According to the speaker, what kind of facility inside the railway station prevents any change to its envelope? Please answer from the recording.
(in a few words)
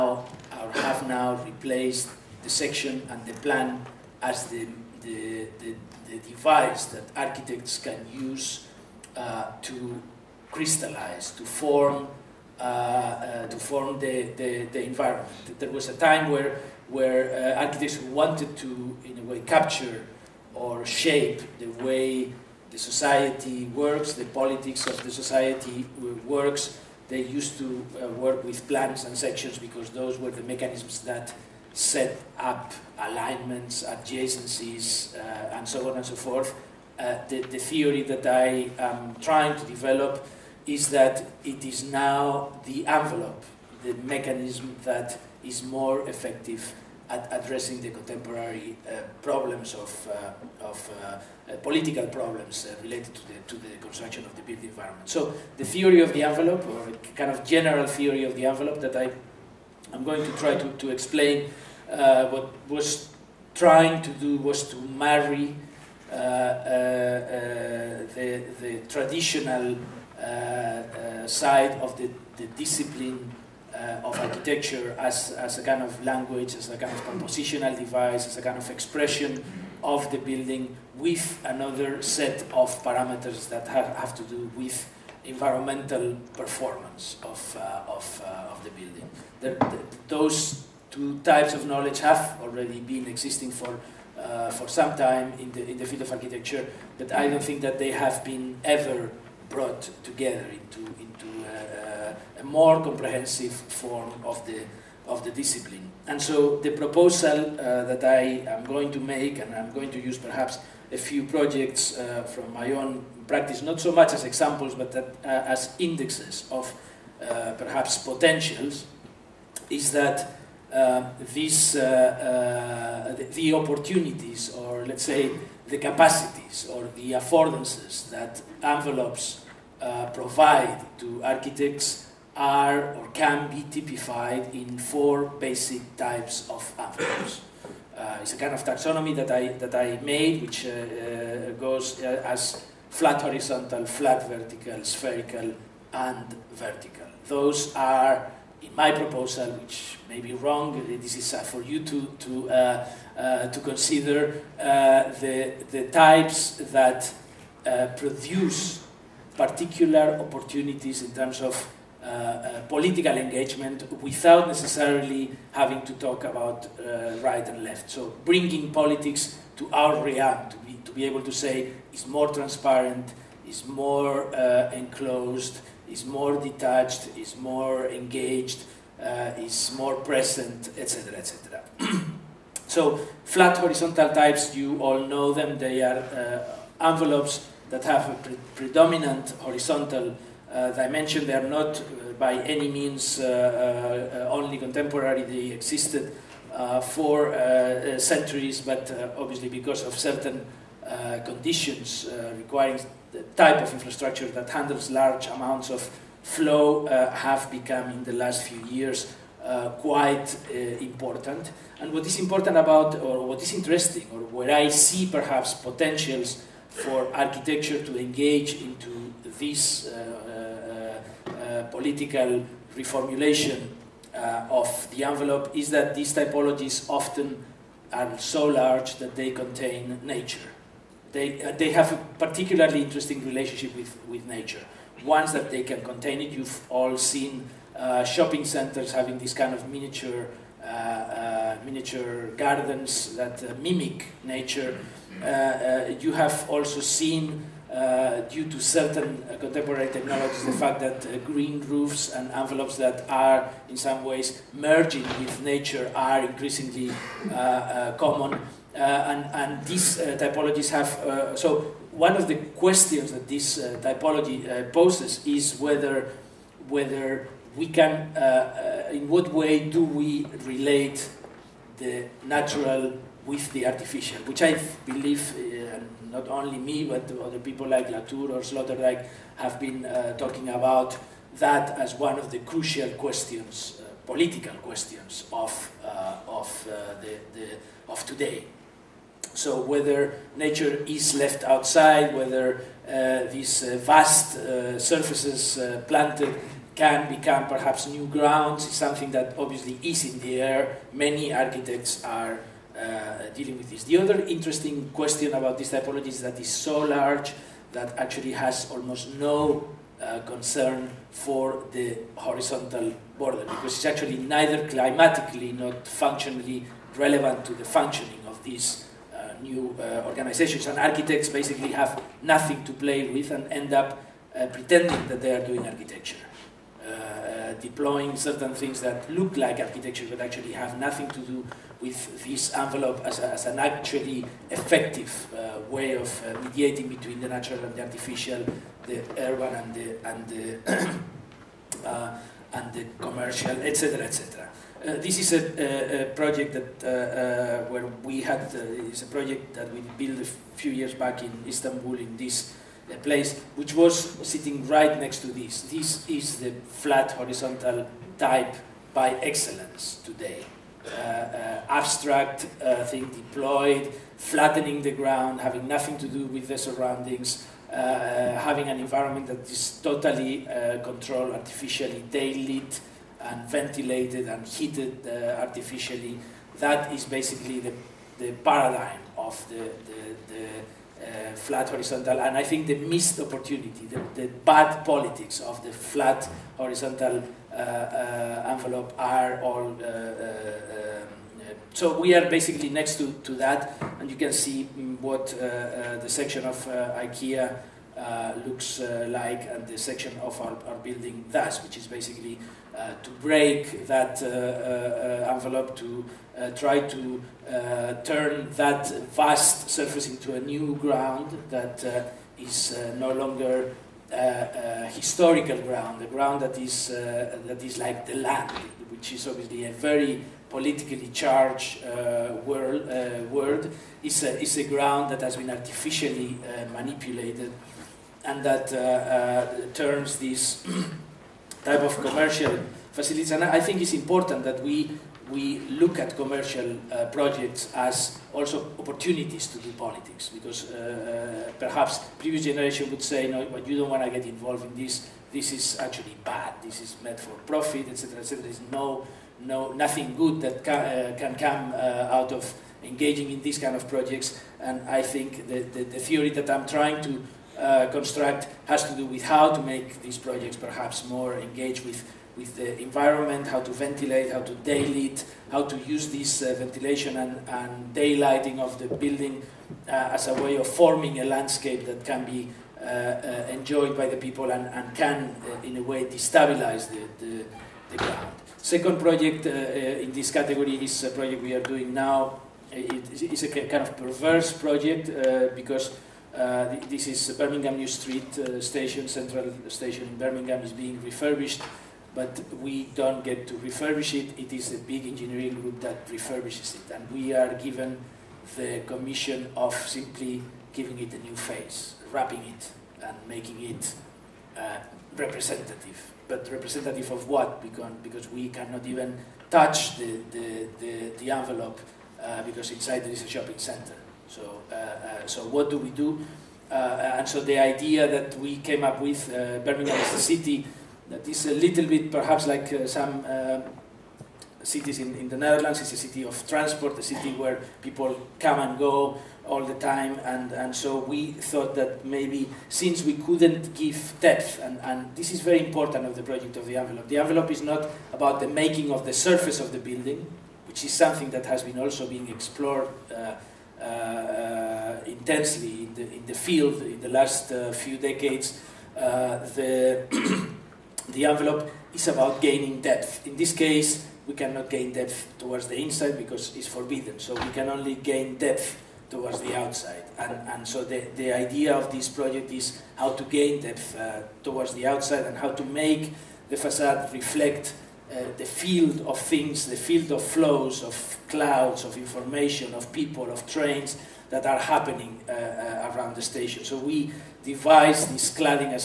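a shopping center.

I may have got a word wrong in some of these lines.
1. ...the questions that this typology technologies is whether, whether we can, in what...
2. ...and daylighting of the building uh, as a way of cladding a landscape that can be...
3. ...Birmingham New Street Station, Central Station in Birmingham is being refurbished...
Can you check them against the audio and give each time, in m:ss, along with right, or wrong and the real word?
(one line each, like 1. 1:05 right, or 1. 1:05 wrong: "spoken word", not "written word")
1. 4:22 wrong: "poses", not "technologies"
2. 7:47 wrong: "forming", not "cladding"
3. 8:07 right.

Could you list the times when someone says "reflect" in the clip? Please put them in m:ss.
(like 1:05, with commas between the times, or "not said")
9:27.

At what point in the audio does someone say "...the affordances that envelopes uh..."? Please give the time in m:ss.
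2:06.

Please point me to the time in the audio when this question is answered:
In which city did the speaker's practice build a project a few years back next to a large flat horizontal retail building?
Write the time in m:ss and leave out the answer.
5:51.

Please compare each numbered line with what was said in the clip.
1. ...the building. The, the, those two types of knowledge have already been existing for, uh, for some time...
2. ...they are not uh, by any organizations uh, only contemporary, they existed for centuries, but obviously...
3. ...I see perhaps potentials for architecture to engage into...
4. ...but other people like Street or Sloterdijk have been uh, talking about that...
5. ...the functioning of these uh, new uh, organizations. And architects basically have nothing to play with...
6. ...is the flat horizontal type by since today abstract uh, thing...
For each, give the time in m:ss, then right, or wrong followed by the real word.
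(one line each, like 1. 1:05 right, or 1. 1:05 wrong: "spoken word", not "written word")
1. 1:28 right
2. 3:11 wrong: "means", not "organizations"
3. 3:34 right
4. 4:36 wrong: "Latour", not "Street"
5. 5:17 right
6. 5:56 wrong: "excellence", not "since".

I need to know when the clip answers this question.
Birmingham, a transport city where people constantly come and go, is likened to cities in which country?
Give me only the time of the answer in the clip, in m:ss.
8:45.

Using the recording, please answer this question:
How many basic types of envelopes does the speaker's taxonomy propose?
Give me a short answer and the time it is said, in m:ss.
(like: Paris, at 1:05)
4, at 2:14.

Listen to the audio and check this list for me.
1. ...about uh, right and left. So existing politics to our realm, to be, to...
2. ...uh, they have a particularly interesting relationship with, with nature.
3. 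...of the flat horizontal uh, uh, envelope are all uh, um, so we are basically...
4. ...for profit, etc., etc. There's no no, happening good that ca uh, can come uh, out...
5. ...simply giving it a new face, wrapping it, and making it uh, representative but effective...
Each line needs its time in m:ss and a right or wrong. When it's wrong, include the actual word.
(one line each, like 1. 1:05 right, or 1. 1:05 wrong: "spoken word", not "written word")
1. 2:46 wrong: "bringing", not "existing"
2. 3:51 right
3. 6:25 right
4. 7:27 wrong: "nothing", not "happening"
5. 8:19 wrong: "representative", not "effective".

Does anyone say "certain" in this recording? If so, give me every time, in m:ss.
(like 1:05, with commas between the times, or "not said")
3:19, 4:08, 5:28.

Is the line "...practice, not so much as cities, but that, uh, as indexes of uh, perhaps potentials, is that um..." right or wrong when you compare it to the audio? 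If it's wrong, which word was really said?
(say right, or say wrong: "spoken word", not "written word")
wrong: "examples", not "cities".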